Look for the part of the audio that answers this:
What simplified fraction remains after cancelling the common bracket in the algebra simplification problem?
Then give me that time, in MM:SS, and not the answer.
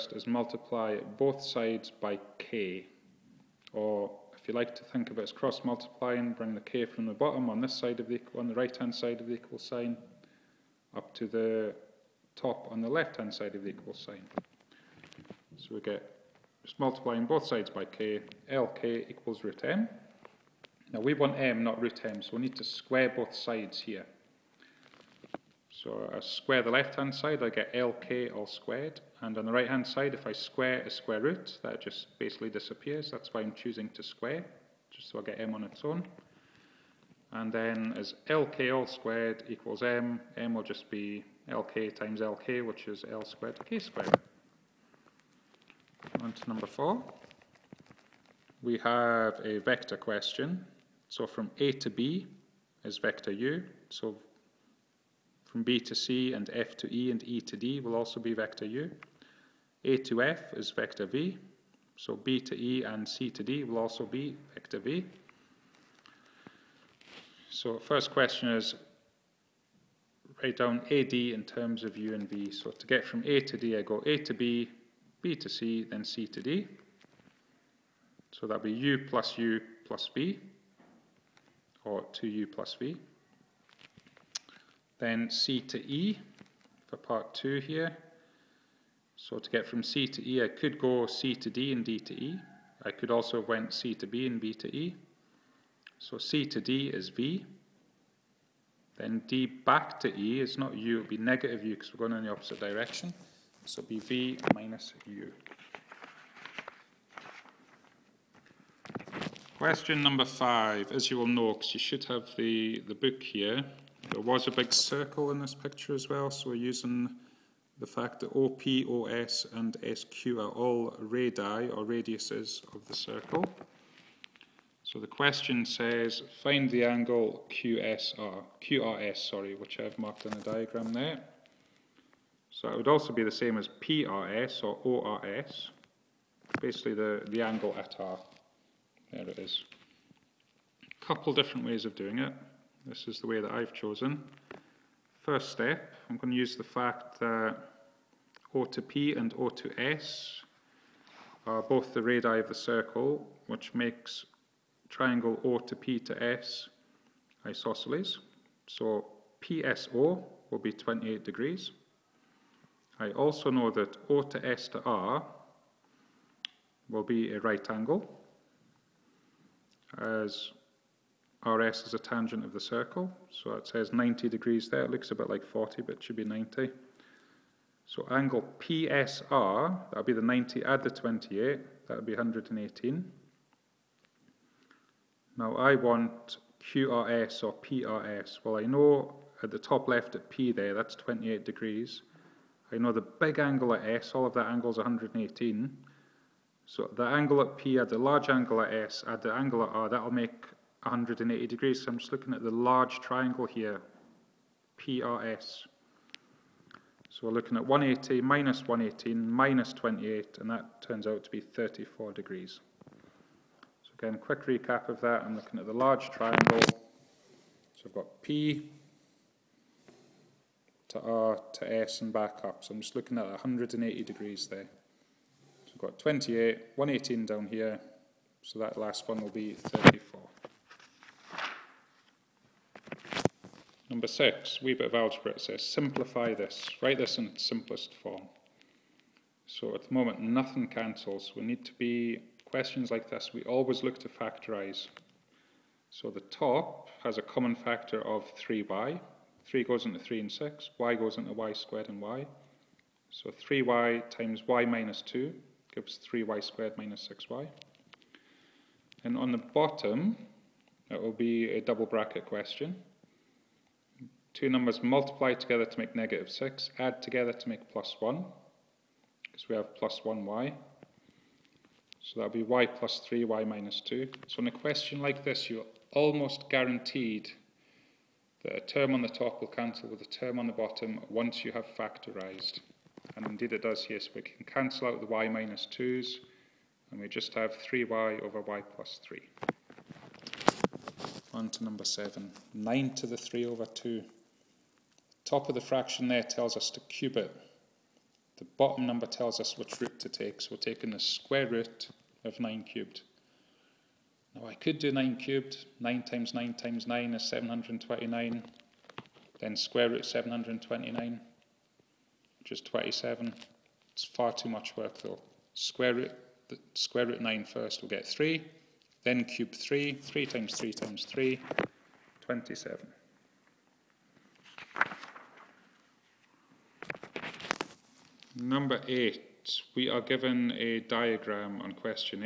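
04:47.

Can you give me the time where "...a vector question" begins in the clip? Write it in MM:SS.
00:49.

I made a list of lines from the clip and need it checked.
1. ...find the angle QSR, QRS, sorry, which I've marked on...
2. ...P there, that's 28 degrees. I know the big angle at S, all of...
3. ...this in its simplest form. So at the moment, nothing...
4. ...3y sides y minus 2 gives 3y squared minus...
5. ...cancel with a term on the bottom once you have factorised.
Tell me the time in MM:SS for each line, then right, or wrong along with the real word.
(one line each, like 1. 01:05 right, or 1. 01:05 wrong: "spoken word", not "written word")
1. 02:06 right
2. 03:10 right
3. 03:56 right
4. 04:13 wrong: "times", not "sides"
5. 04:39 right.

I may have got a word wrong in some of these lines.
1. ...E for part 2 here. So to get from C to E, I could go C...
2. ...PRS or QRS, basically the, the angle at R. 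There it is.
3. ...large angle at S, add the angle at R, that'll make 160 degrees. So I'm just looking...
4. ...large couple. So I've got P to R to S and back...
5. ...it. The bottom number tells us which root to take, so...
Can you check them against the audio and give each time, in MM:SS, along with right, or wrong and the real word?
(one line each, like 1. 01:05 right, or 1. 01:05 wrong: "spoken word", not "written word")
1. 01:25 right
2. 02:13 wrong: "ORS", not "QRS"
3. 03:17 wrong: "180", not "160"
4. 03:35 wrong: "triangle", not "couple"
5. 04:57 right.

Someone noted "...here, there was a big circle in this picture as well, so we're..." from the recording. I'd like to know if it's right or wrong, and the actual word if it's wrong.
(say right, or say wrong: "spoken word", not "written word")
right.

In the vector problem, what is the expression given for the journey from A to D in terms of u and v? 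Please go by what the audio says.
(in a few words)
2U plus V.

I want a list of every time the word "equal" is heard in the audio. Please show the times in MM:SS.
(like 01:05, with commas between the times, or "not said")
00:09, 00:13, 00:19, 00:39.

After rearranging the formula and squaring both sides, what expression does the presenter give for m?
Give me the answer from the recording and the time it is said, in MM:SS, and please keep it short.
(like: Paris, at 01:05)
l squared k squared, at 00:43.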